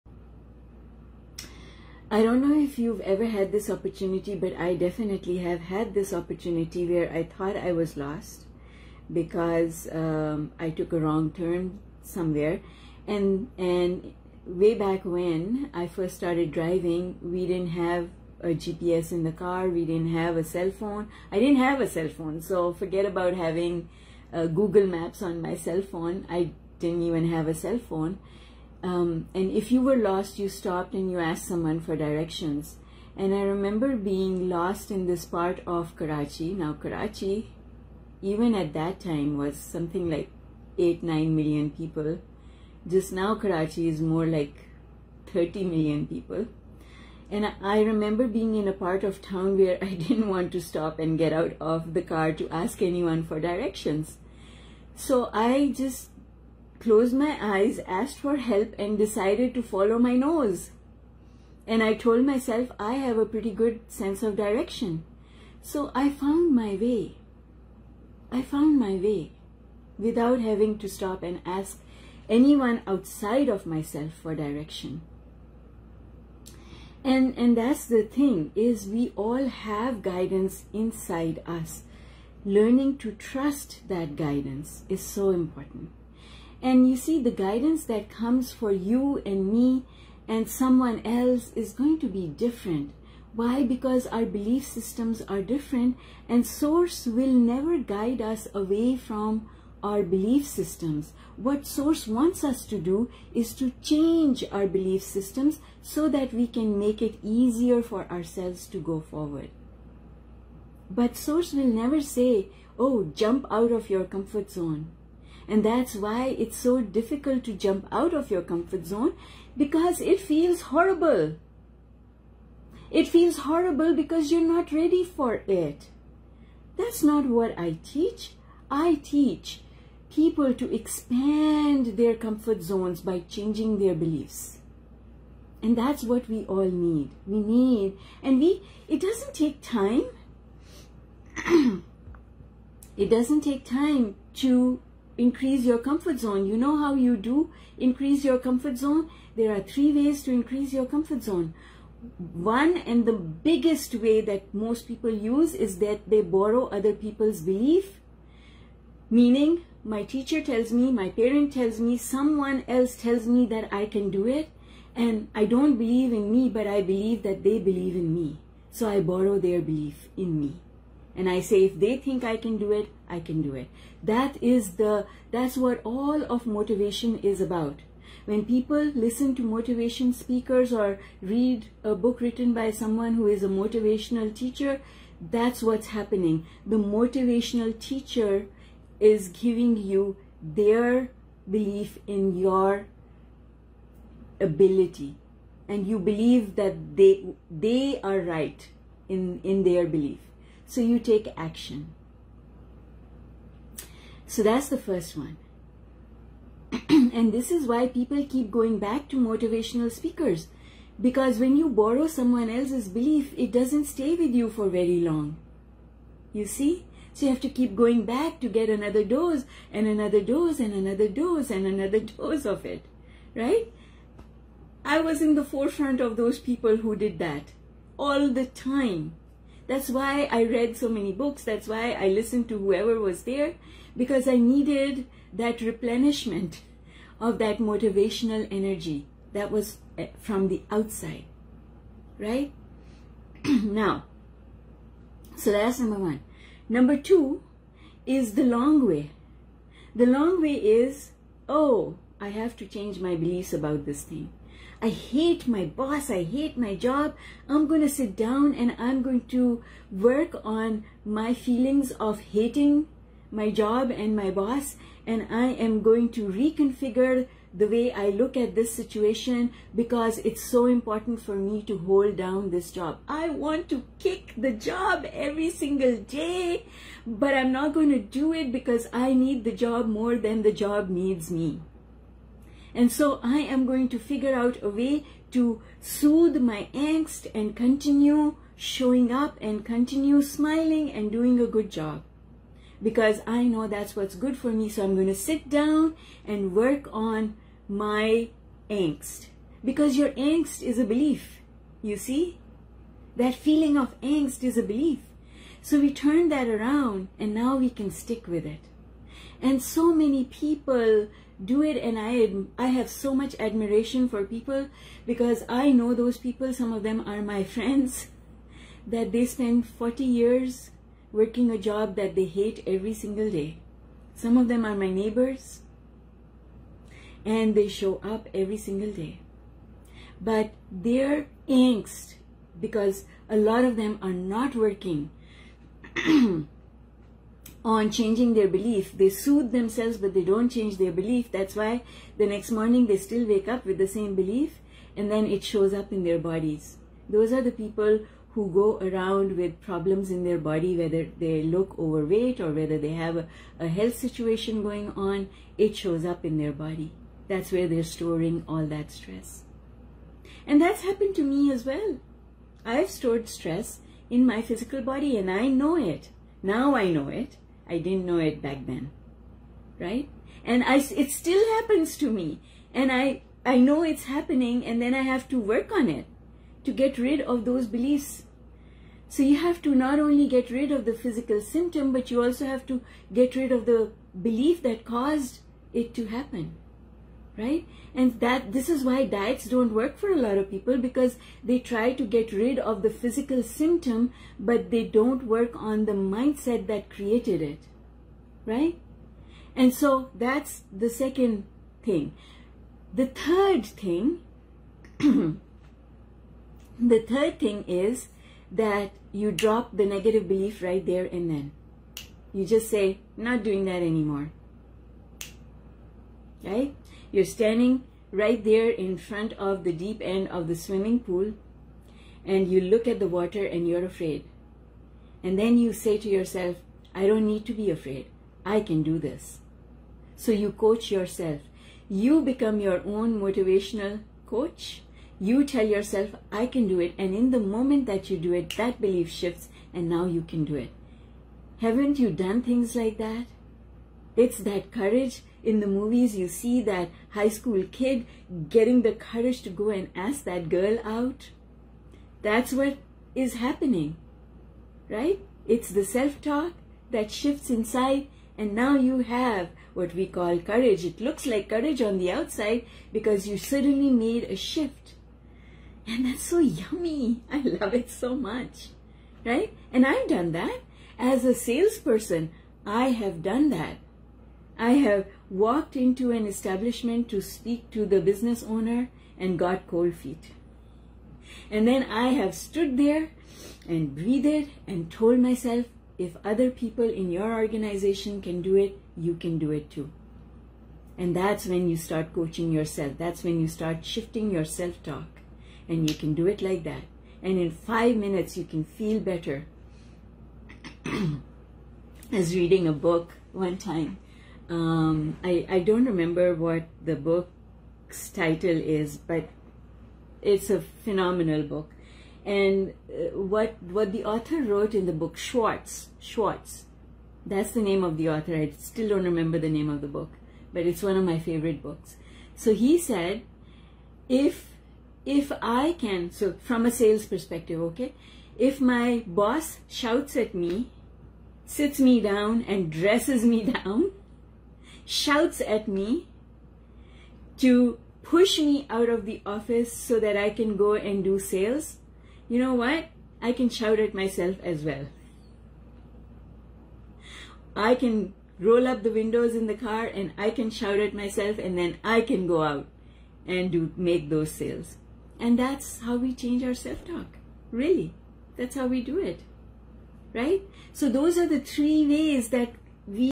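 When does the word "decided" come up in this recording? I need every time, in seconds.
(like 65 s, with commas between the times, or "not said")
58 s.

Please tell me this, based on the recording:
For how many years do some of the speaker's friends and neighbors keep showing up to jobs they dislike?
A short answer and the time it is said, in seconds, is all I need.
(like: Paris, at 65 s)
40, at 319 s.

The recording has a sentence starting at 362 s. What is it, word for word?
I've stored stress in my physical body and I know it.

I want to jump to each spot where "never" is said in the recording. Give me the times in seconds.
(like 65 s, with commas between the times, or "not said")
97 s, 111 s.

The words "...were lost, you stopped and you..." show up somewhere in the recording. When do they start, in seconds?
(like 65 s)
29 s.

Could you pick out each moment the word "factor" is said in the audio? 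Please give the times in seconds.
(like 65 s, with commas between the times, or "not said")
not said.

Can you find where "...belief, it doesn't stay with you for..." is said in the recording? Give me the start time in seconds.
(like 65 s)
212 s.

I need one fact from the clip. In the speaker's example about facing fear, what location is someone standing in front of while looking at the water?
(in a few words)
Deep end of the swimming pool.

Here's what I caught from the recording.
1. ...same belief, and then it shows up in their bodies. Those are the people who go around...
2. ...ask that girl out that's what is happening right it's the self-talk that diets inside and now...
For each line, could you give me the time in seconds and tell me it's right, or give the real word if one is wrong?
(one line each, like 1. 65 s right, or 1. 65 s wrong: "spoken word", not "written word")
1. 343 s right
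2. 449 s wrong: "shifts", not "diets".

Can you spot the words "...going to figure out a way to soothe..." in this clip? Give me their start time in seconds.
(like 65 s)
283 s.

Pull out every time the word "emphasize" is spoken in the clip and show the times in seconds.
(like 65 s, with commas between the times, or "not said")
not said.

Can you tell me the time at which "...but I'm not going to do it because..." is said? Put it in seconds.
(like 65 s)
277 s.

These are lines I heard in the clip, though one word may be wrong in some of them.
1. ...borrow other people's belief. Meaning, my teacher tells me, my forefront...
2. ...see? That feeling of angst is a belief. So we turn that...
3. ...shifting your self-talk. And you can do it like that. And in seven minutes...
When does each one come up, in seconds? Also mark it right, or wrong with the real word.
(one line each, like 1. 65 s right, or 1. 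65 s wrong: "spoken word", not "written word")
1. 156 s wrong: "parent", not "forefront"
2. 301 s right
3. 493 s wrong: "five", not "seven".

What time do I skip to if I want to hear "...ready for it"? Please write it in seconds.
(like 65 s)
124 s.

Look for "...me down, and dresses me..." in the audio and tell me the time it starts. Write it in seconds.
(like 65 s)
531 s.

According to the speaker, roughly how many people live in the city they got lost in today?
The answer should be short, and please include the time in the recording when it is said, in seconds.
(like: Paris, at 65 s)
30 million, at 45 s.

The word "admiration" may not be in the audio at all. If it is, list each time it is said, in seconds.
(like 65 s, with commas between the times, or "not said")
313 s.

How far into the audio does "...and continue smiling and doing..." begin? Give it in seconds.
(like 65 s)
289 s.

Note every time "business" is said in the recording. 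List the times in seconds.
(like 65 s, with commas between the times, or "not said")
477 s.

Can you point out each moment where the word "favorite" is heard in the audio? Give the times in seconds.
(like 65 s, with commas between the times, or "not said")
521 s.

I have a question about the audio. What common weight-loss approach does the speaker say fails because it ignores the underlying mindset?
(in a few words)
Diets.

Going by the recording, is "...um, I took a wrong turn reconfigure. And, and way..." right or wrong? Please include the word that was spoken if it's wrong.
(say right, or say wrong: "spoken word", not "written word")
wrong: "somewhere", not "reconfigure".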